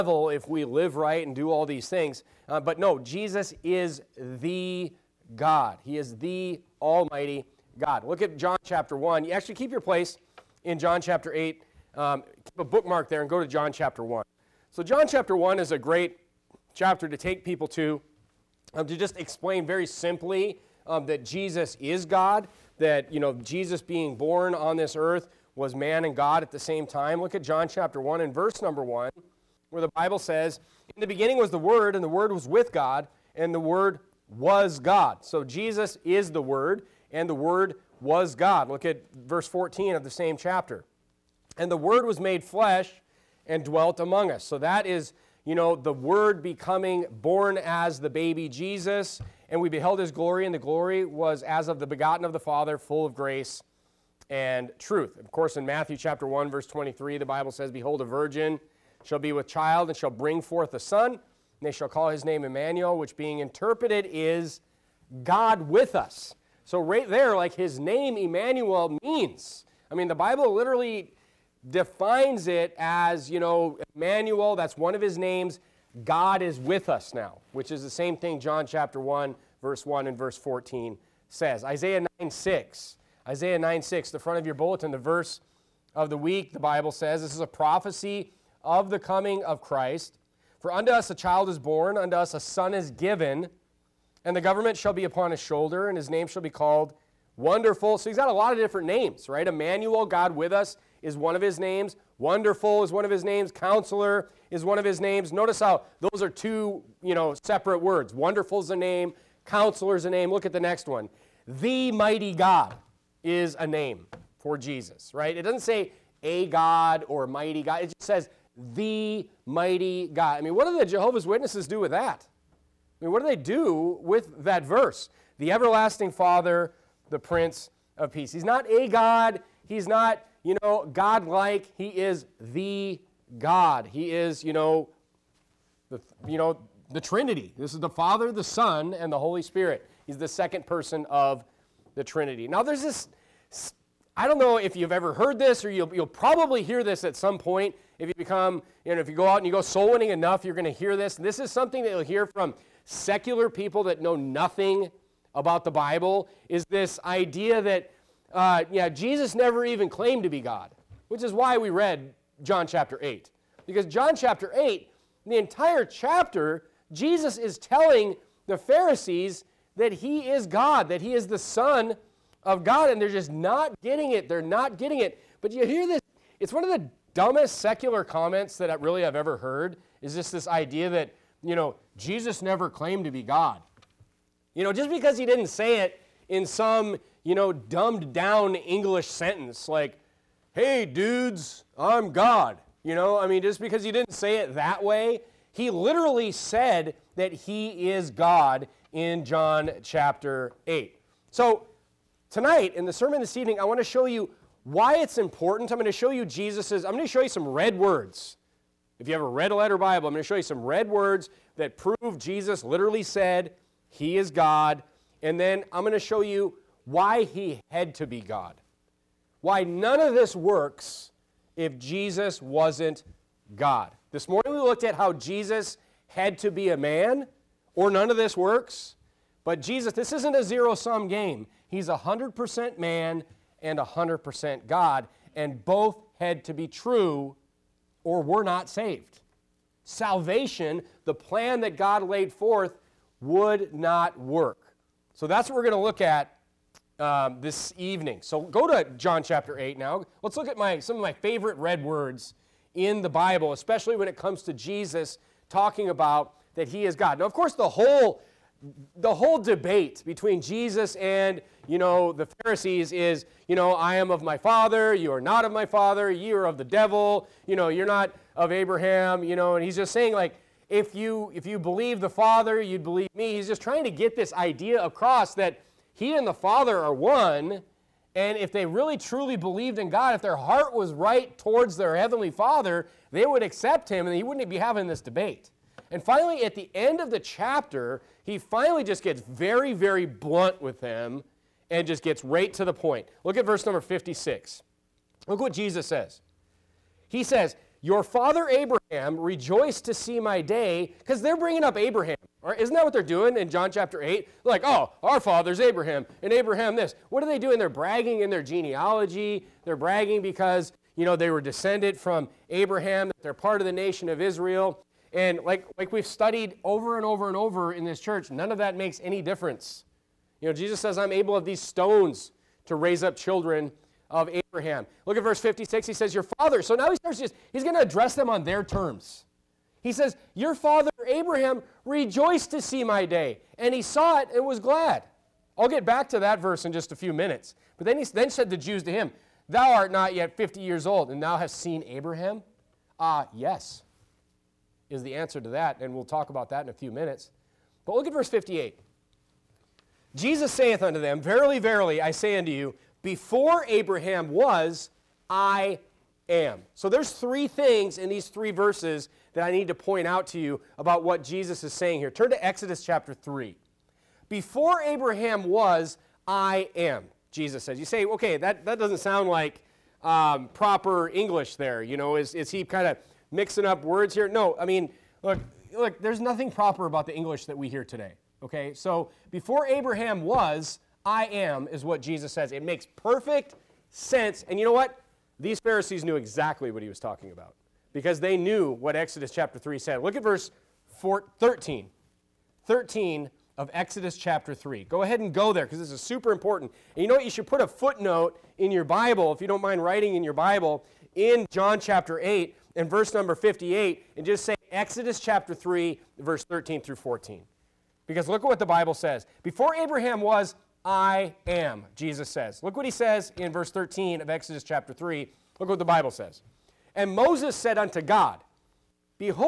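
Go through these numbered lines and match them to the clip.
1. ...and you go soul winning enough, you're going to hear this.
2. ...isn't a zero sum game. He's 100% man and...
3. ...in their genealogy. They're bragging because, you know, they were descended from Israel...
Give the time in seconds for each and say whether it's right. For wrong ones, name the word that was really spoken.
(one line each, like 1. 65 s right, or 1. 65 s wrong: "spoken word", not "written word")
1. 149 s right
2. 230 s right
3. 308 s wrong: "Abraham", not "Israel".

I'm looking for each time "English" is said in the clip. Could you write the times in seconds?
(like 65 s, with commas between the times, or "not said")
188 s, 371 s, 377 s.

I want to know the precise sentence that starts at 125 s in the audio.
The everlasting Father, the Prince of Peace.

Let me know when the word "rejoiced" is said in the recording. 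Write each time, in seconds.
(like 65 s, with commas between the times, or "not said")
299 s, 331 s.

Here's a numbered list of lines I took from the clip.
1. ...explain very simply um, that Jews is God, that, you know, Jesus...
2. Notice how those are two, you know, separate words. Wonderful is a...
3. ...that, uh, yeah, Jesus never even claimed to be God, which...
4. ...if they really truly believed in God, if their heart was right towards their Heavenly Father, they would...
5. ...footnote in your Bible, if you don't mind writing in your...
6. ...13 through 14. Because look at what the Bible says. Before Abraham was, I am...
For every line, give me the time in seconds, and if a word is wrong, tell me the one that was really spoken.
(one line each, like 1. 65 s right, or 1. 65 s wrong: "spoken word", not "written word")
1. 19 s wrong: "Jesus", not "Jews"
2. 105 s right
3. 157 s right
4. 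278 s right
5. 397 s right
6. 406 s right.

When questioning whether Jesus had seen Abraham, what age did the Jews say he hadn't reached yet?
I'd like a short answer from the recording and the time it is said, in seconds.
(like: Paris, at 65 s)
50 years old, at 340 s.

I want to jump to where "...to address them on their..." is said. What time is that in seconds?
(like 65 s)
327 s.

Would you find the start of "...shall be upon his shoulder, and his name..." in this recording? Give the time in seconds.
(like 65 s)
94 s.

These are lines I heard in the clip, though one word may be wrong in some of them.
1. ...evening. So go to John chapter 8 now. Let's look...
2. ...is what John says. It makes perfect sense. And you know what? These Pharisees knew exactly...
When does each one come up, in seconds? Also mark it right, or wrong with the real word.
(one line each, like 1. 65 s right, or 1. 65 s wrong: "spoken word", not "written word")
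1. 247 s right
2. 381 s wrong: "Jesus", not "John".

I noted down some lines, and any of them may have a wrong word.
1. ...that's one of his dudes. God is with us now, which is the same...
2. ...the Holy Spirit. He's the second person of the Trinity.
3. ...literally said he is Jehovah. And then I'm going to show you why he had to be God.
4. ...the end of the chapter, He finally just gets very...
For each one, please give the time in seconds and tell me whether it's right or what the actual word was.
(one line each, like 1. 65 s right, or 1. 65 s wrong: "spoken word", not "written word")
1. 74 s wrong: "names", not "dudes"
2. 139 s right
3. 212 s wrong: "God", not "Jehovah"
4. 286 s right.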